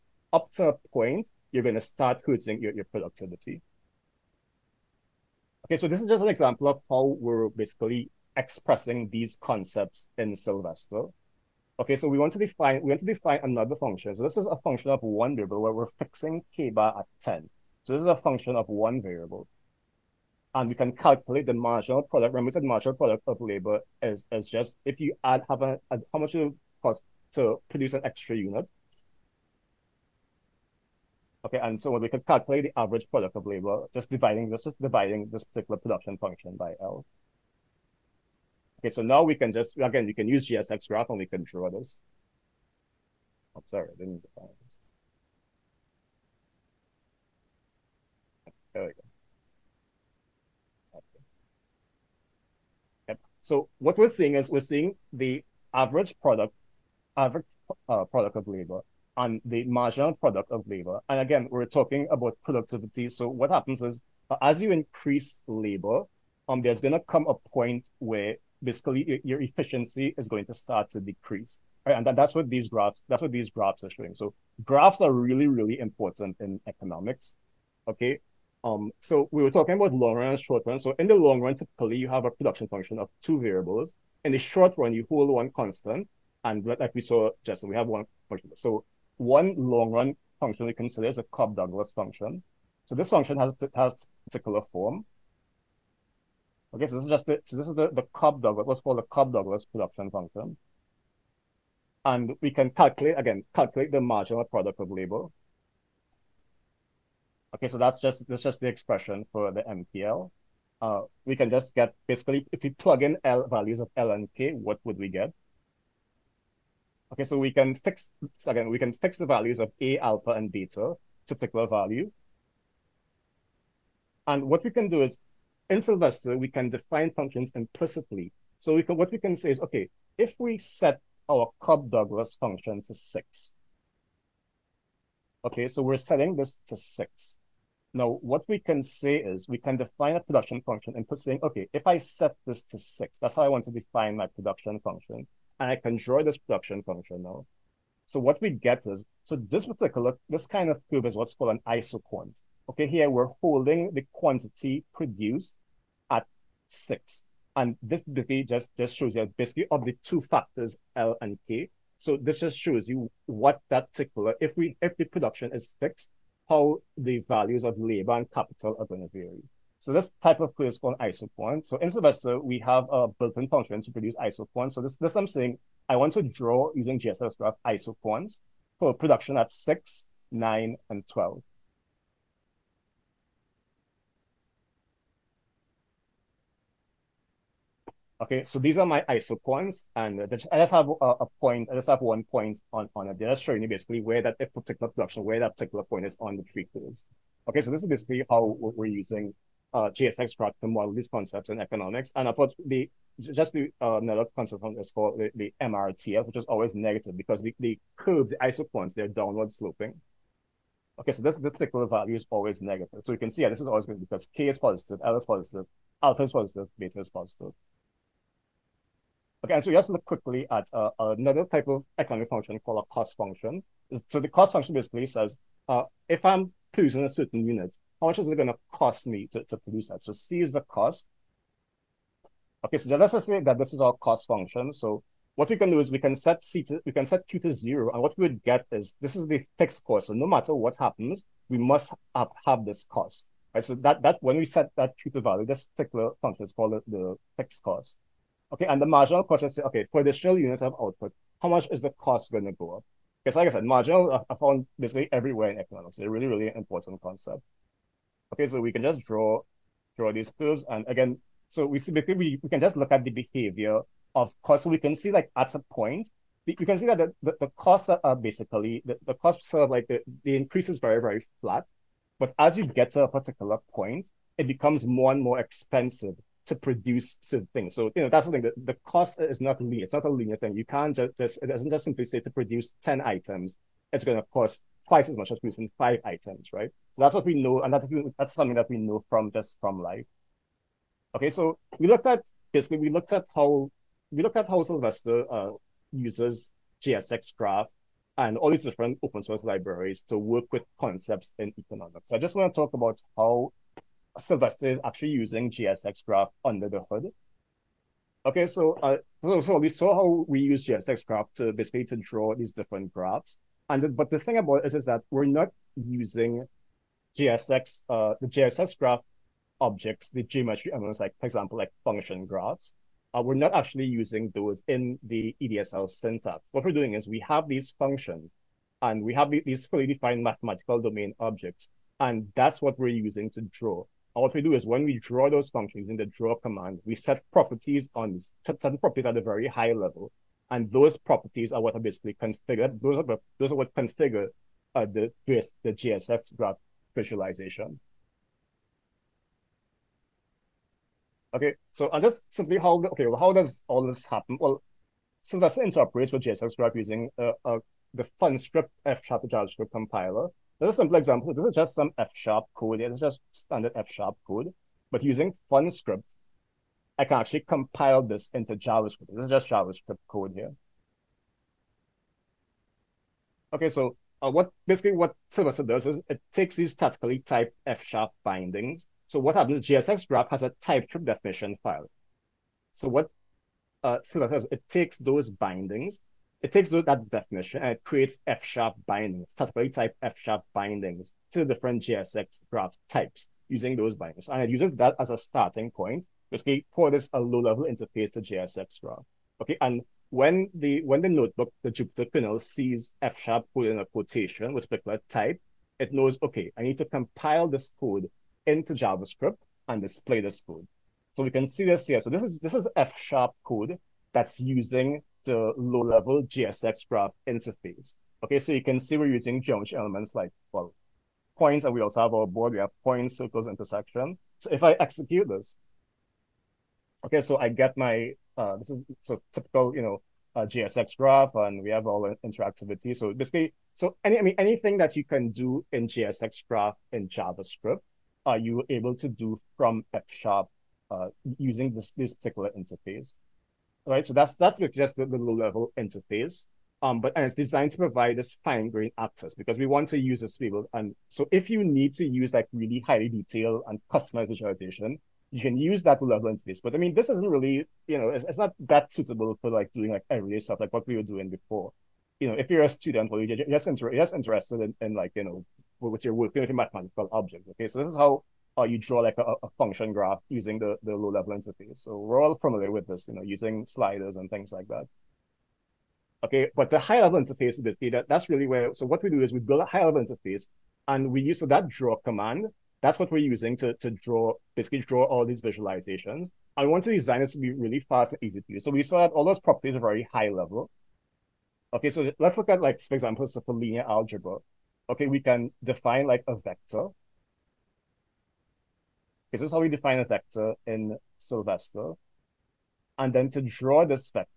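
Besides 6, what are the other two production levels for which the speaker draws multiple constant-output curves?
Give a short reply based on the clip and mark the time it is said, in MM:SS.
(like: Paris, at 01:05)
9 and 12, at 03:00.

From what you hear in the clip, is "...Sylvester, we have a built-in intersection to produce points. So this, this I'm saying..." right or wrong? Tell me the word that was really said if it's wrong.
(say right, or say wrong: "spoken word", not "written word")
wrong: "function", not "intersection".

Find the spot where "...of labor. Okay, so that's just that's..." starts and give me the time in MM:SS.
01:44.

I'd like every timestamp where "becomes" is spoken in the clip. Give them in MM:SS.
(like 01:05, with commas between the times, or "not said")
04:34.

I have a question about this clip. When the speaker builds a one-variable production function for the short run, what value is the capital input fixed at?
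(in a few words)
10.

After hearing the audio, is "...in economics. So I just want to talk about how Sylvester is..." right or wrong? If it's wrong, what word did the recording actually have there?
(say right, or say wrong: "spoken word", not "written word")
right.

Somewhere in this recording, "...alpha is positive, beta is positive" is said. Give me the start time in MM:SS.
03:36.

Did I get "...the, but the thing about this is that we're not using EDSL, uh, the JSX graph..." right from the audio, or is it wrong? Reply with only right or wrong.
wrong.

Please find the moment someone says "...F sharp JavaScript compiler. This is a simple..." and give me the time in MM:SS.
05:58.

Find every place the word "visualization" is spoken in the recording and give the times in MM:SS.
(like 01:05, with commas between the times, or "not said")
05:46, 07:34, 08:05.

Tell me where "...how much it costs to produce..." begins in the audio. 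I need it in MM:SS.
00:25.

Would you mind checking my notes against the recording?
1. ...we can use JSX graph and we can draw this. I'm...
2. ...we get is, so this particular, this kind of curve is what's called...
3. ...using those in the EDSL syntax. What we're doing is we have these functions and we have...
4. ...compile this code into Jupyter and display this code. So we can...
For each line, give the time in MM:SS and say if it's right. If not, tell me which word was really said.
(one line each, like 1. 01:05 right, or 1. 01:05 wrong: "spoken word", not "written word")
1. 00:40 right
2. 02:28 right
3. 05:23 right
4. 06:46 wrong: "JavaScript", not "Jupyter".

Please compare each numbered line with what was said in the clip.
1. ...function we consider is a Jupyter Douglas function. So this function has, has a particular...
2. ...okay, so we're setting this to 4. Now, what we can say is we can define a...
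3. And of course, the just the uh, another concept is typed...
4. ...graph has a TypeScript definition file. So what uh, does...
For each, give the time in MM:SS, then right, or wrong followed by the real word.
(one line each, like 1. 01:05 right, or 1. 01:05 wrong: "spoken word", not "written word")
1. 01:30 wrong: "Cobb", not "Jupyter"
2. 02:15 wrong: "6", not "4"
3. 03:22 wrong: "called", not "typed"
4. 06:20 right.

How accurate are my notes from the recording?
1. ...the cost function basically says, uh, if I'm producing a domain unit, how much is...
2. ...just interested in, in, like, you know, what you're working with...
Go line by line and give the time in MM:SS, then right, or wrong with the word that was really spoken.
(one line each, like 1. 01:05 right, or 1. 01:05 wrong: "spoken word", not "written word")
1. 03:44 wrong: "certain", not "domain"
2. 07:43 right.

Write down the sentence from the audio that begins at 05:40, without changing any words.
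And those properties are what are basically configured.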